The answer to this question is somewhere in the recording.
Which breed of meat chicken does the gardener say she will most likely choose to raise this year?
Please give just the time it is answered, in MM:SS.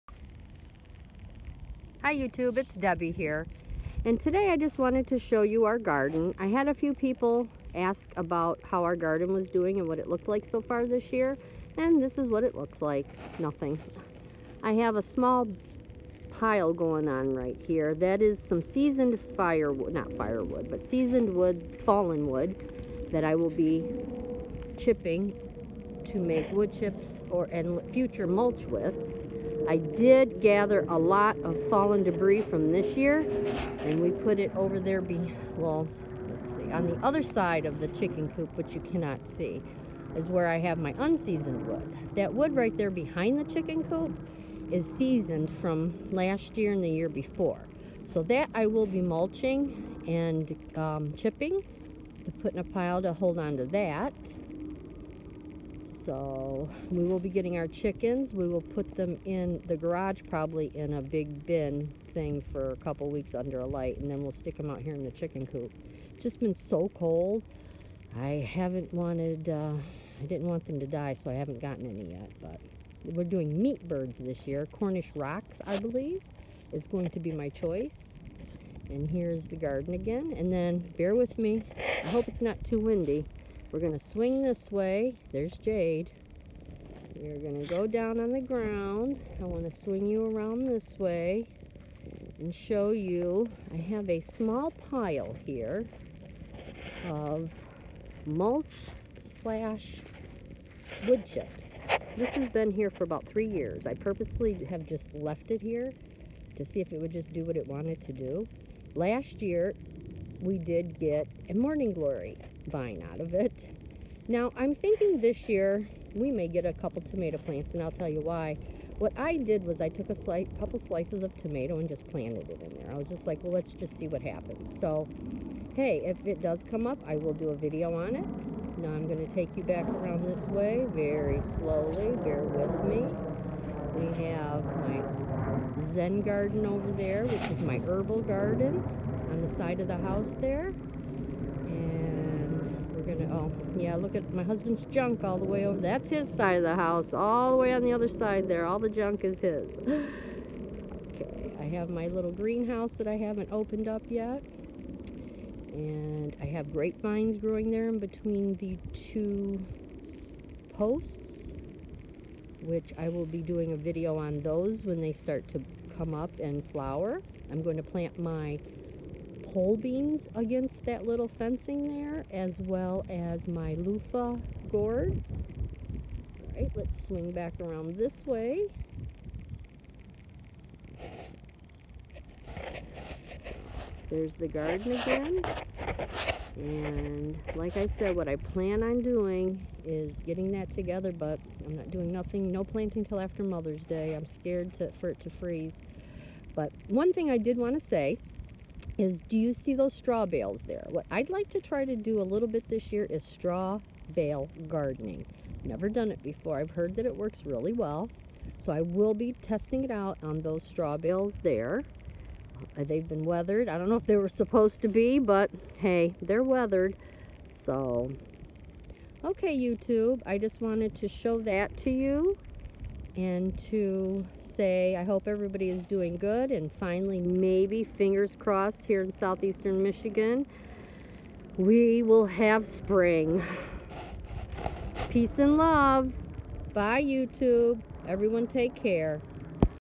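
01:14.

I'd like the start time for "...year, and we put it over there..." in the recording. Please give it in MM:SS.
00:32.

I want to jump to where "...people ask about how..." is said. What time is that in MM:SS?
00:06.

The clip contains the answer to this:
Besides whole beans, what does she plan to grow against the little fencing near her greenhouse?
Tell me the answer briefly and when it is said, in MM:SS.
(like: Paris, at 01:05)
loofah gourds, at 02:53.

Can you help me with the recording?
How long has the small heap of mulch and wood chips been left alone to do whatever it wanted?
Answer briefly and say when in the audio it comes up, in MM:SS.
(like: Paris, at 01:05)
about 3 years, at 01:43.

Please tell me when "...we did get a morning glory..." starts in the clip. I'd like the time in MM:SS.
01:50.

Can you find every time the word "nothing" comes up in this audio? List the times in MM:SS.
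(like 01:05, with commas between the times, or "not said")
00:13, 03:12.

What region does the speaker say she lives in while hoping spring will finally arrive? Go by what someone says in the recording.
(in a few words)
southeastern Michigan.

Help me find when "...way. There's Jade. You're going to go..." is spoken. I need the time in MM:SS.
01:24.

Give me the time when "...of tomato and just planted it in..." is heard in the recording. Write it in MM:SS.
02:01.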